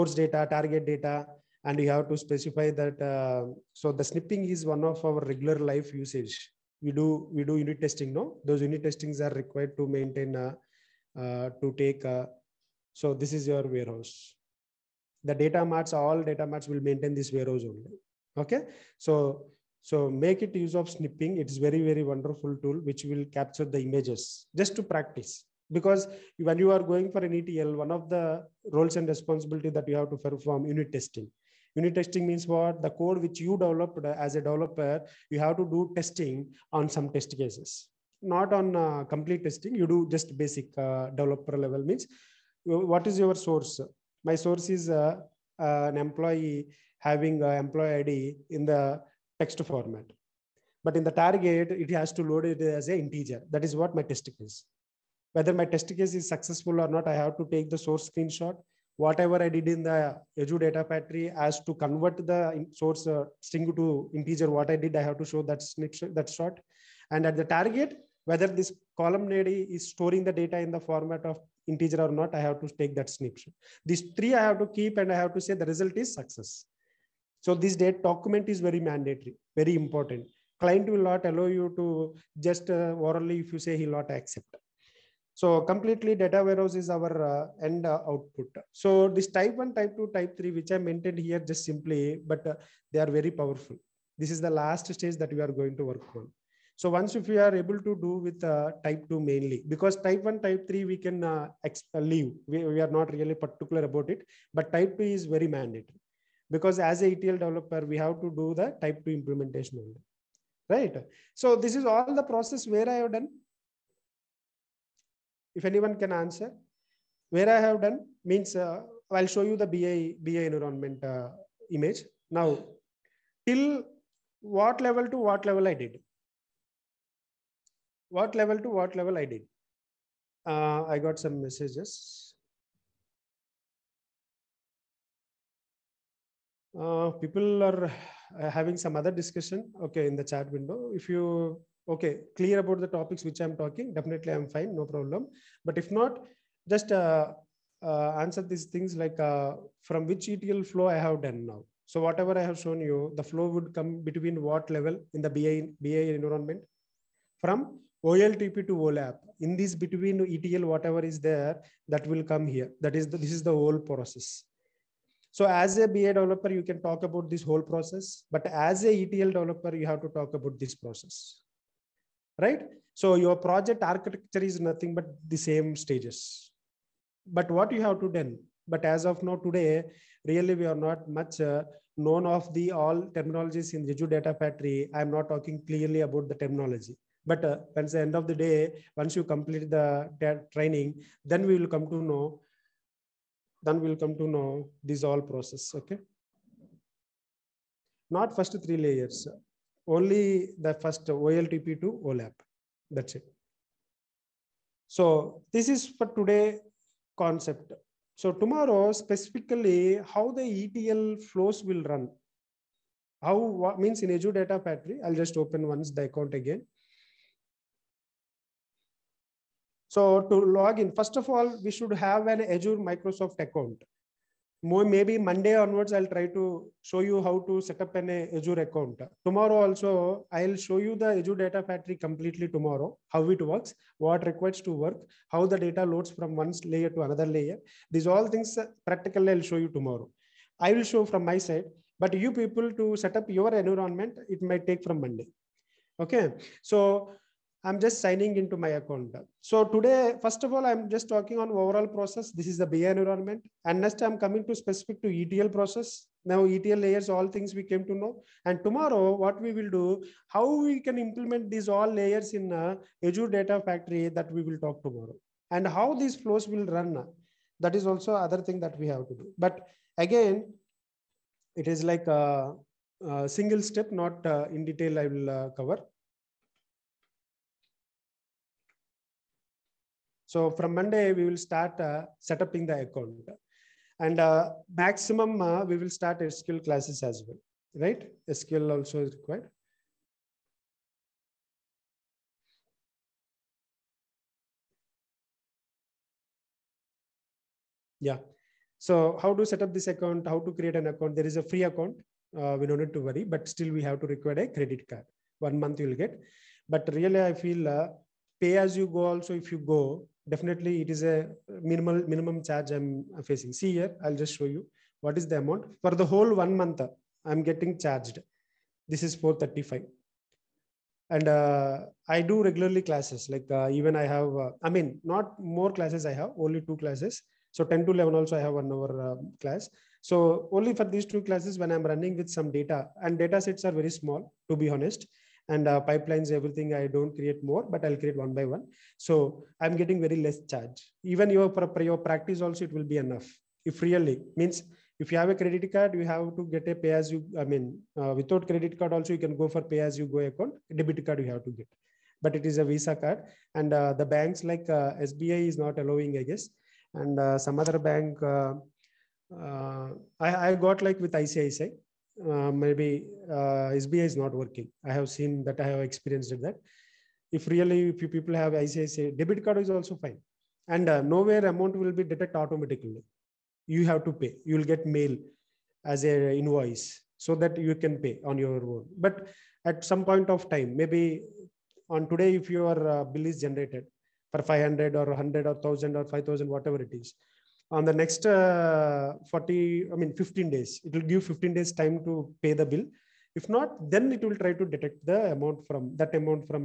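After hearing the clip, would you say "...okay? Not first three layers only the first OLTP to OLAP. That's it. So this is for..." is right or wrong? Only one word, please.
right.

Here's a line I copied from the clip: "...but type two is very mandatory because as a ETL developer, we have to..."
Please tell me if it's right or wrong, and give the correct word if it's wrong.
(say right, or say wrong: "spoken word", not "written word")
right.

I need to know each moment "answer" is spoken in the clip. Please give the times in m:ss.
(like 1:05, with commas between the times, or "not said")
1:56, 2:28.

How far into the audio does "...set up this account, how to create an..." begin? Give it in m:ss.
4:59.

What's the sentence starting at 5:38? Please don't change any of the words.
So I'm getting very less charge.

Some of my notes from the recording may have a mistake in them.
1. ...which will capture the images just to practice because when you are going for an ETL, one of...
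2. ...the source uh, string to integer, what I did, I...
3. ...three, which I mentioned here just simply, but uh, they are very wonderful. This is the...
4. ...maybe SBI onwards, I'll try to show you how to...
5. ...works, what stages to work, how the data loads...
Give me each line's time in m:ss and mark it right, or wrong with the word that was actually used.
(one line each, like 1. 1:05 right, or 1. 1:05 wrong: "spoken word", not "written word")
1. 0:22 right
2. 1:02 right
3. 1:30 wrong: "powerful", not "wonderful"
4. 3:44 wrong: "Monday", not "SBI"
5. 3:53 wrong: "requires", not "stages".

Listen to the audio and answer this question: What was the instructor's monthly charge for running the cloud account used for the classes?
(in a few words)
435.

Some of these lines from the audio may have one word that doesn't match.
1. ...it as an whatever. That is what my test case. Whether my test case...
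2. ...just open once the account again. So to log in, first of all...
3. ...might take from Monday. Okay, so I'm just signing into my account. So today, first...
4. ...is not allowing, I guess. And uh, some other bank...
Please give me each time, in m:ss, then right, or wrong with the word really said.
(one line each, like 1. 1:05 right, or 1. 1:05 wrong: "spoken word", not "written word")
1. 0:52 wrong: "integer", not "whatever"
2. 3:35 right
3. 4:04 right
4. 5:55 right.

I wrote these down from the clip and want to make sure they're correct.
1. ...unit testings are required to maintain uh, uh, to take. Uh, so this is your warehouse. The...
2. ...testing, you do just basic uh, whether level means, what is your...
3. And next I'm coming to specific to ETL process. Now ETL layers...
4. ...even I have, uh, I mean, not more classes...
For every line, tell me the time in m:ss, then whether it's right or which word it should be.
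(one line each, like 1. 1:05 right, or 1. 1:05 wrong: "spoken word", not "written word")
1. 0:08 right
2. 0:39 wrong: "developer", not "whether"
3. 4:13 right
4. 5:23 right.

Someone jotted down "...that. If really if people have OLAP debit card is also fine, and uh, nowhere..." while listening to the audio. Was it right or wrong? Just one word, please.
wrong.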